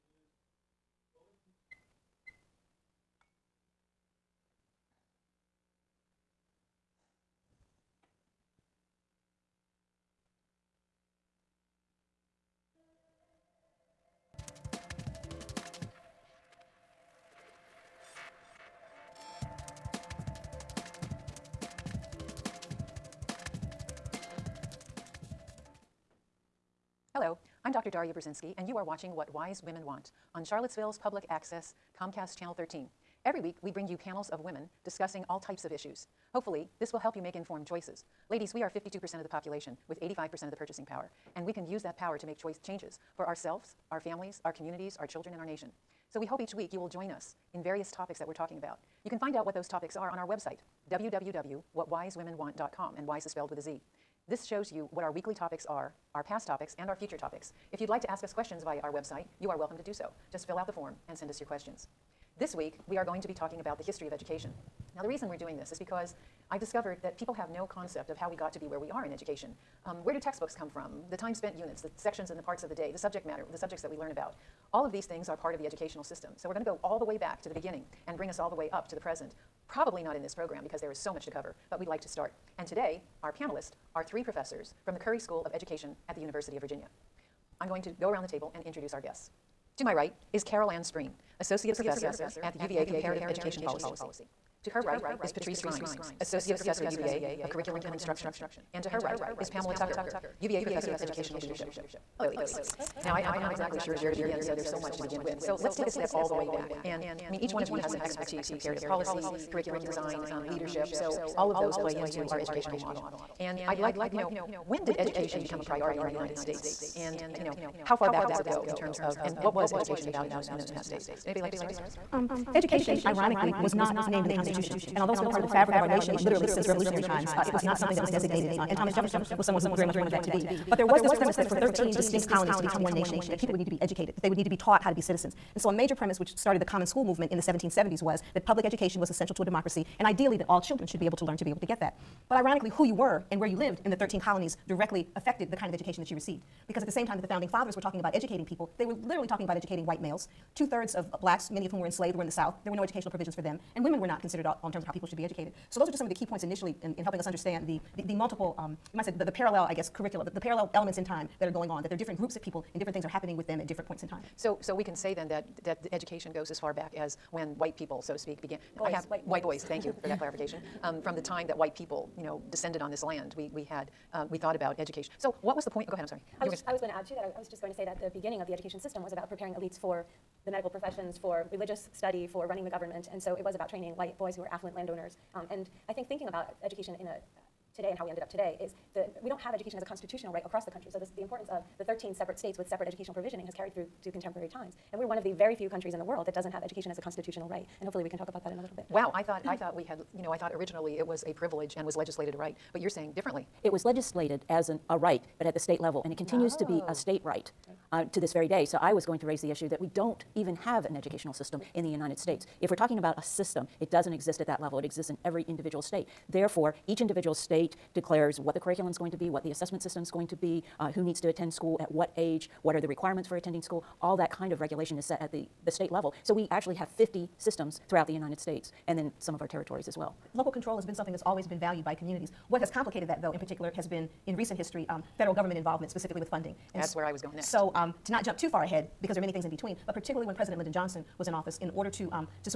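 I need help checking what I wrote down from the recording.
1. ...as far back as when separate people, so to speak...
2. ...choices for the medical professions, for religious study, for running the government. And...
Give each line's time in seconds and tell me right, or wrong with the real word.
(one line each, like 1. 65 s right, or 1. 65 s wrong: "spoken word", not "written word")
1. 166 s wrong: "white", not "separate"
2. 179 s wrong: "elites", not "choices".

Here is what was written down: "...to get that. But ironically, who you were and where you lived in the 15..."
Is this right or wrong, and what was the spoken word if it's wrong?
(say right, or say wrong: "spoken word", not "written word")
wrong: "13", not "15".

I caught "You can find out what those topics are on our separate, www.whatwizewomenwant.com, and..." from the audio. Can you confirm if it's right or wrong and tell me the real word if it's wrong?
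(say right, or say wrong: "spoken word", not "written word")
wrong: "website", not "separate".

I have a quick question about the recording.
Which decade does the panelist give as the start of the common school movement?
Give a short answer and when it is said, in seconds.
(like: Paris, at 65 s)
1770s, at 137 s.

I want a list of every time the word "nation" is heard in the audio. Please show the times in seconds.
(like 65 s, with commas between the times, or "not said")
45 s, 125 s, 132 s.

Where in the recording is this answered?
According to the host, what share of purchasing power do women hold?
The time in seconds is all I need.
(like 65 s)
40 s.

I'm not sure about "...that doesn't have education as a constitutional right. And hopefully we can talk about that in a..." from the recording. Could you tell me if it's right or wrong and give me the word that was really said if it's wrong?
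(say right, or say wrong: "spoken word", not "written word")
right.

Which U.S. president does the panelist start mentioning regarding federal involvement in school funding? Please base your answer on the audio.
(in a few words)
Lyndon Johnson.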